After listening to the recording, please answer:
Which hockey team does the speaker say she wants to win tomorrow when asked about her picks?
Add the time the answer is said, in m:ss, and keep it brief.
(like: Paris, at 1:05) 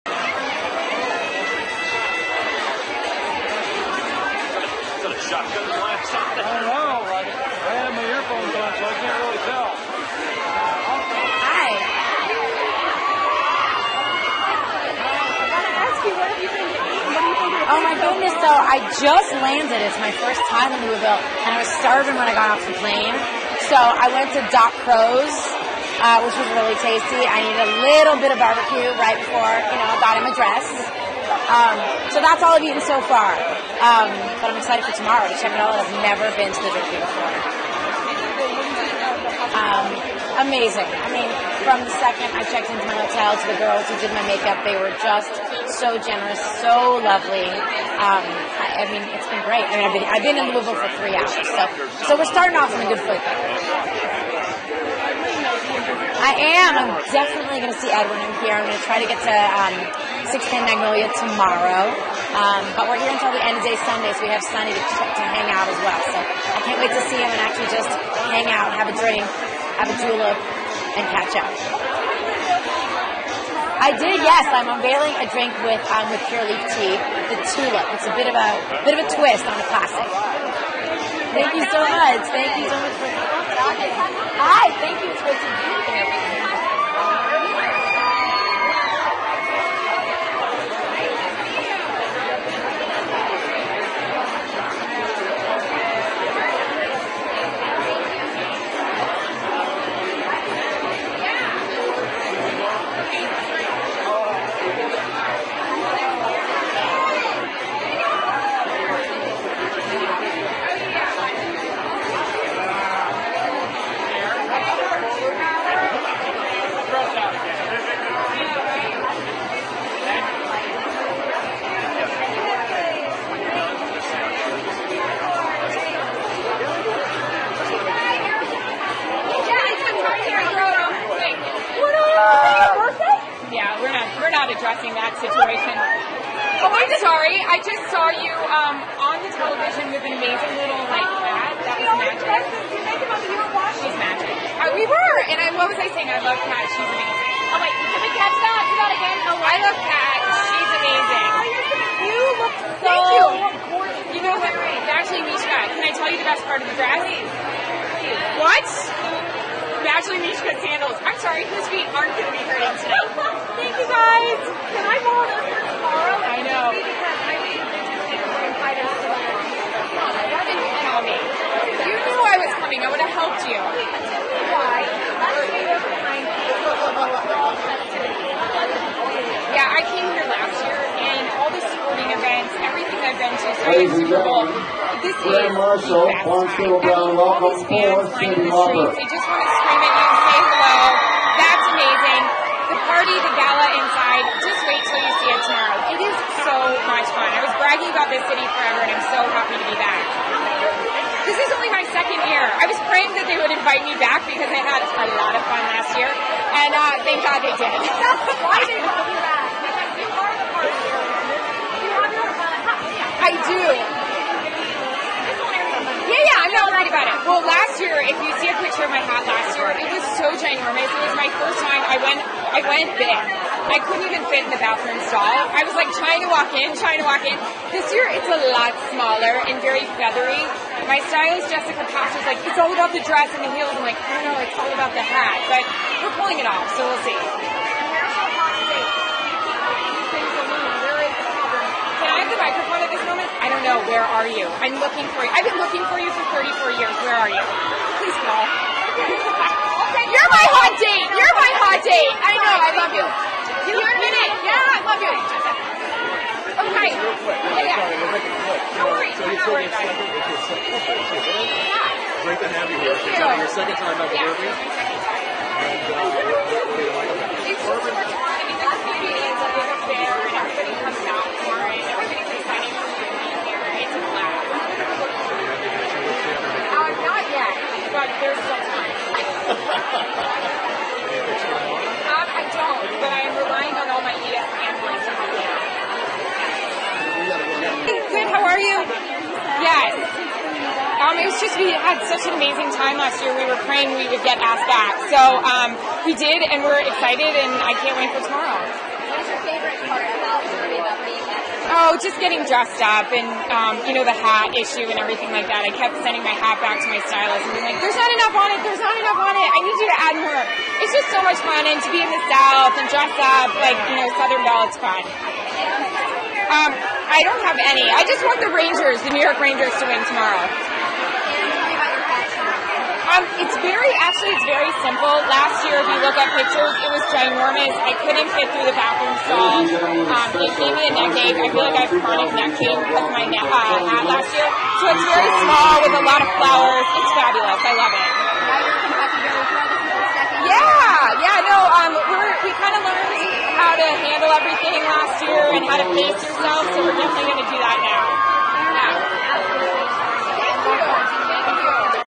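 New York Rangers, at 5:19.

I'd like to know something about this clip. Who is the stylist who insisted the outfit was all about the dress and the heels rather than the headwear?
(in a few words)
Jessica Pass.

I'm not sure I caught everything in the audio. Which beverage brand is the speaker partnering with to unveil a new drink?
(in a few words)
Pure Leaf.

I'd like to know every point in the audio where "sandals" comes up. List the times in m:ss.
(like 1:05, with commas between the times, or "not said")
2:40, 2:47.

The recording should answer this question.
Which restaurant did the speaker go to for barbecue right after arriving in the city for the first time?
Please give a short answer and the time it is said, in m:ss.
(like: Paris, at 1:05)
Doc Crow's, at 0:24.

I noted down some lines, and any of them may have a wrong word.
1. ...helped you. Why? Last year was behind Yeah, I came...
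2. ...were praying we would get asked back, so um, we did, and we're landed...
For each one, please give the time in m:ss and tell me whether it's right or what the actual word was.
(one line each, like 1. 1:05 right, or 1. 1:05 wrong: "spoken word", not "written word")
1. 2:53 right
2. 4:53 wrong: "excited", not "landed".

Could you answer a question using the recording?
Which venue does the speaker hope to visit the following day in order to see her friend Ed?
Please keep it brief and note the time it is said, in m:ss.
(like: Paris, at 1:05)
610 Magnolia, at 1:00.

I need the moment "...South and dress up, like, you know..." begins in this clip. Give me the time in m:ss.
5:12.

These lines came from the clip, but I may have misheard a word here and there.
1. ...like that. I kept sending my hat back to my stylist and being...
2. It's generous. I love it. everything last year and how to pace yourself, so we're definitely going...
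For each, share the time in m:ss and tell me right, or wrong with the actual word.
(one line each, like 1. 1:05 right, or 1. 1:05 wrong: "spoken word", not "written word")
1. 5:05 right
2. 5:36 wrong: "fabulous", not "generous".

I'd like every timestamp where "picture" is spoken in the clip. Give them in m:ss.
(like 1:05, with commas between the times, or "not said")
3:38, 5:26.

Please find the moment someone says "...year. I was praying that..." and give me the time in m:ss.
3:22.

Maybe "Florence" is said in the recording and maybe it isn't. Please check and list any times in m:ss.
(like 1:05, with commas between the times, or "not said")
3:06.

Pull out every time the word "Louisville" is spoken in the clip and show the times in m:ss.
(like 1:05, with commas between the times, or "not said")
0:20, 0:50.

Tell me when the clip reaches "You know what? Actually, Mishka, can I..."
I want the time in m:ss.
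2:34.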